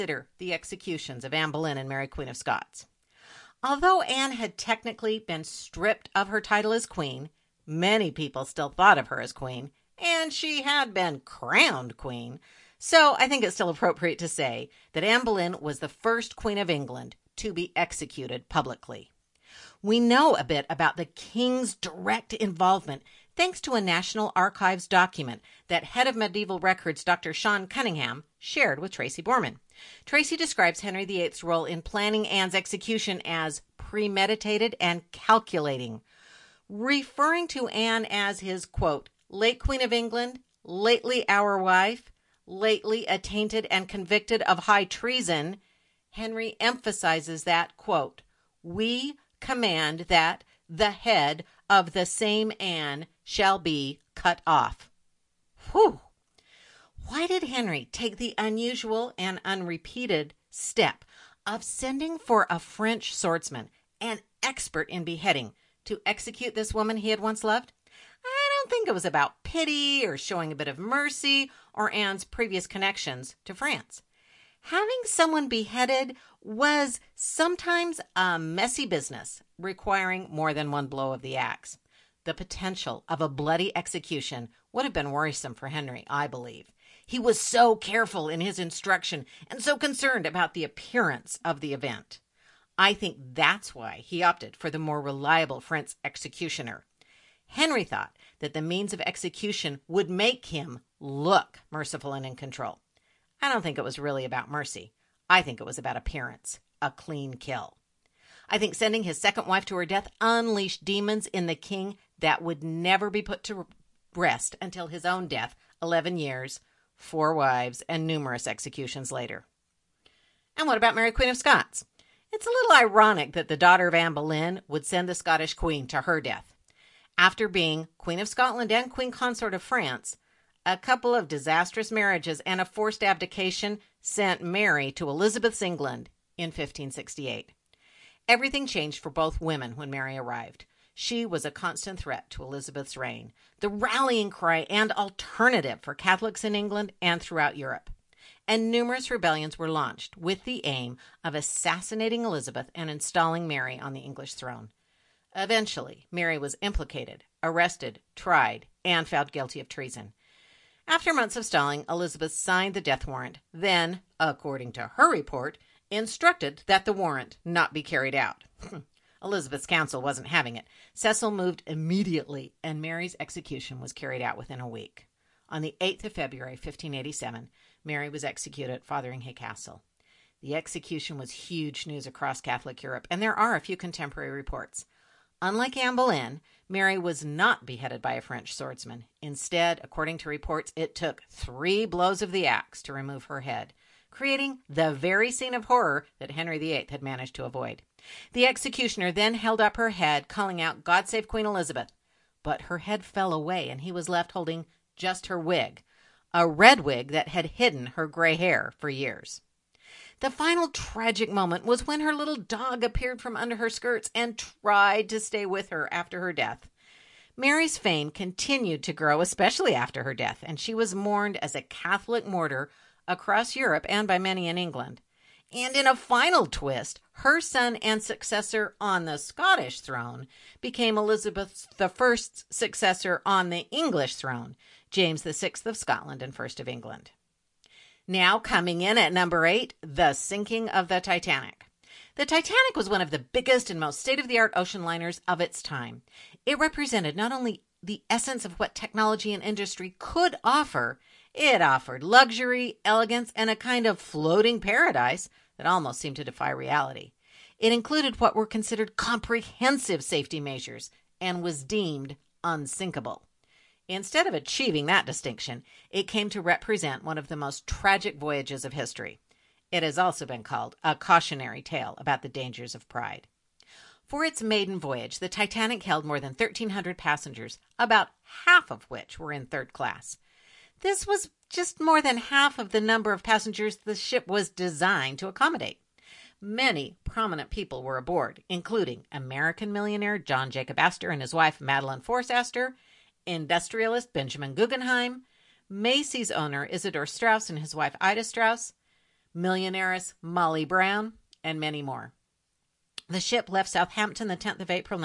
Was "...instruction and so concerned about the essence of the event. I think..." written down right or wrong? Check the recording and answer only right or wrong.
wrong.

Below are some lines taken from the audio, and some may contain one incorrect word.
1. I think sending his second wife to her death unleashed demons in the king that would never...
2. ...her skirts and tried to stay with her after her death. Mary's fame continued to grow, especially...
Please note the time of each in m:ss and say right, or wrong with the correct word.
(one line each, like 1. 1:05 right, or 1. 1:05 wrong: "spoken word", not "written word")
1. 1:48 right
2. 3:33 right.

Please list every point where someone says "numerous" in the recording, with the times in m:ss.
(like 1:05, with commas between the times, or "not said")
1:58, 2:28.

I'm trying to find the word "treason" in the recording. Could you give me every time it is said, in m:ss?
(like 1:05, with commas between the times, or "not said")
0:44, 2:39.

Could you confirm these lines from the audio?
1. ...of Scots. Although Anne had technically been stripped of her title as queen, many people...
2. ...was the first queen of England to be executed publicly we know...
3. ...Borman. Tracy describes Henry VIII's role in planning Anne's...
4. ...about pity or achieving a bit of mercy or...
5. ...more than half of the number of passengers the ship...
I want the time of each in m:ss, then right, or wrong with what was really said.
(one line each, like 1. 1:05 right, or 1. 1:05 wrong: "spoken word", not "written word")
1. 0:02 right
2. 0:15 right
3. 0:29 right
4. 1:09 wrong: "showing", not "achieving"
5. 4:41 right.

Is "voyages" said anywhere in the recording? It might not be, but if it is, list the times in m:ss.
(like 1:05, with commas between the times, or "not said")
4:28, 4:34.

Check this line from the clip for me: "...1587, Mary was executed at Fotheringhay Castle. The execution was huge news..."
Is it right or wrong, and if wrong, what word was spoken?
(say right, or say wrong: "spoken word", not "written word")
right.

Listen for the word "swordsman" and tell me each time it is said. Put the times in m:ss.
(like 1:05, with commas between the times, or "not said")
1:03, 3:08.